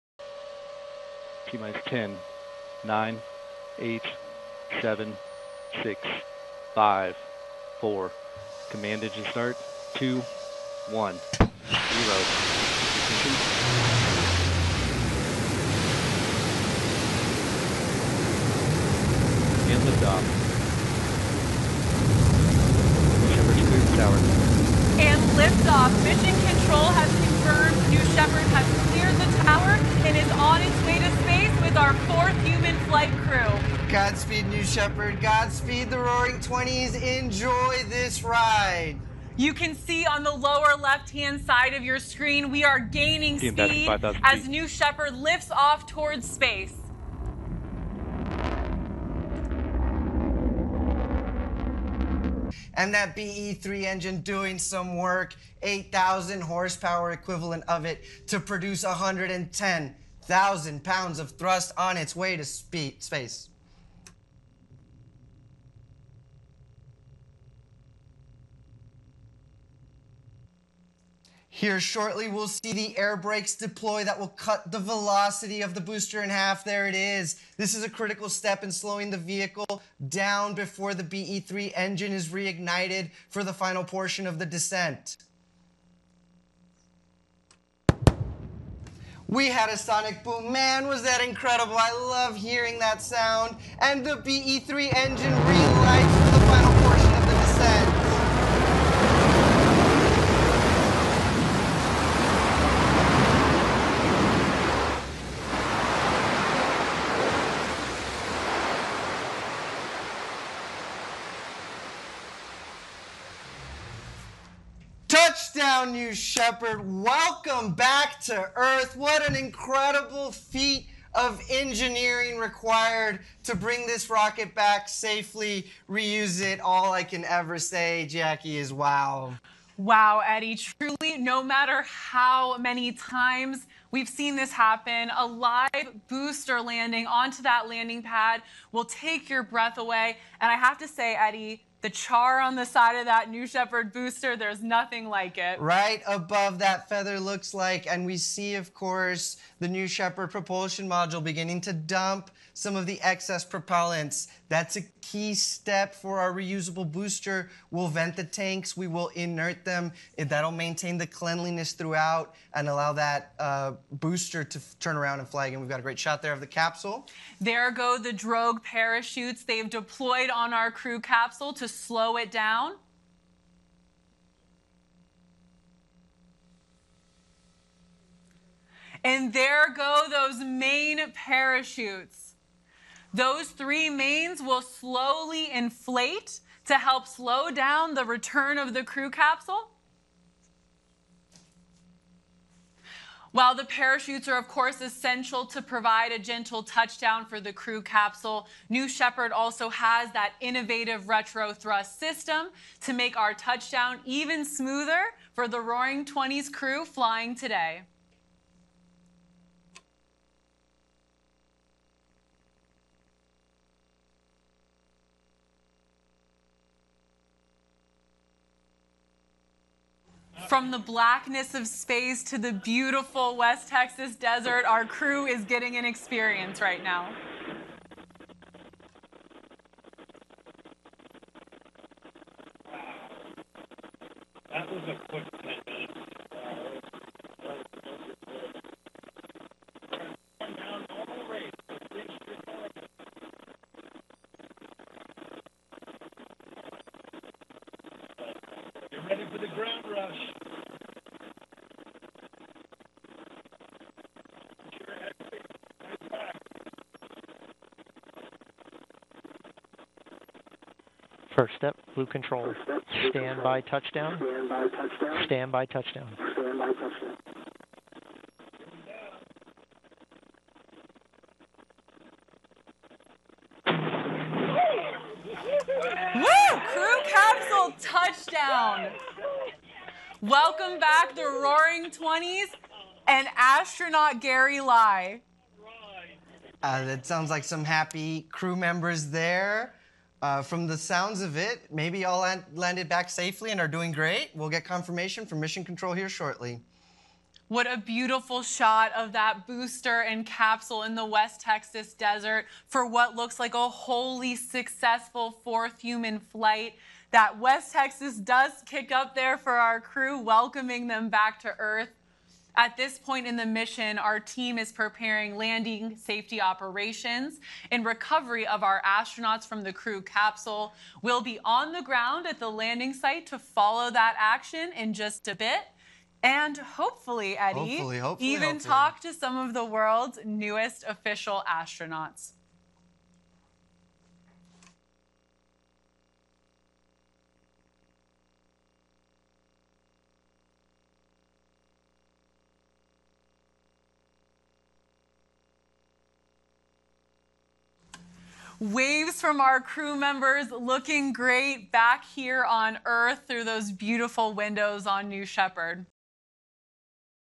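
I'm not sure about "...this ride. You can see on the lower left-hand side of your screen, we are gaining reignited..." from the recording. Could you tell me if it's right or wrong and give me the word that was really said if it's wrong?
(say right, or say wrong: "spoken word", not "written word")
wrong: "speed", not "reignited".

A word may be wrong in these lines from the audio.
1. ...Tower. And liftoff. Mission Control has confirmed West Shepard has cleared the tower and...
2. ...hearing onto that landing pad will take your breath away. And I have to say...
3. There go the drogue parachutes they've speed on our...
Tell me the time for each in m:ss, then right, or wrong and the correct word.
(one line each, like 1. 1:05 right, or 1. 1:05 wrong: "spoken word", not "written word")
1. 0:23 wrong: "New", not "West"
2. 2:16 wrong: "landing", not "hearing"
3. 2:47 wrong: "deployed", not "speed".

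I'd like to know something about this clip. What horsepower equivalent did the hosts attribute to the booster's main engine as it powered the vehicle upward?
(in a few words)
8,000 horsepower.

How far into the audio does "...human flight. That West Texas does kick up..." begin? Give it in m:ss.
5:05.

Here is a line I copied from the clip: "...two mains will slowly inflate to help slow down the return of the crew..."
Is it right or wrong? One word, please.
wrong.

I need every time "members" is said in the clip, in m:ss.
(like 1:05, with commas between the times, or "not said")
4:48, 5:49.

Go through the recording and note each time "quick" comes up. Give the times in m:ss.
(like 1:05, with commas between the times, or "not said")
3:55.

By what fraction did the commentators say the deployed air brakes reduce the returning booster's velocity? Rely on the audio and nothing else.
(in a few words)
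in half.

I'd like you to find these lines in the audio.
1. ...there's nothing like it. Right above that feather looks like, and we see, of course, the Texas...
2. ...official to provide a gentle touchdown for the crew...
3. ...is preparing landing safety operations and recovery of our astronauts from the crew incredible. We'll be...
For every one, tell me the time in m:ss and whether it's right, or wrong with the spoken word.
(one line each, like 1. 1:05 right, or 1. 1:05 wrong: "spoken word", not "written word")
1. 2:24 wrong: "New", not "Texas"
2. 3:14 wrong: "essential", not "official"
3. 5:14 wrong: "capsule", not "incredible".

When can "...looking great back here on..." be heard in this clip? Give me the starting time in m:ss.
5:50.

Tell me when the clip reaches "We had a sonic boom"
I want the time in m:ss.
1:29.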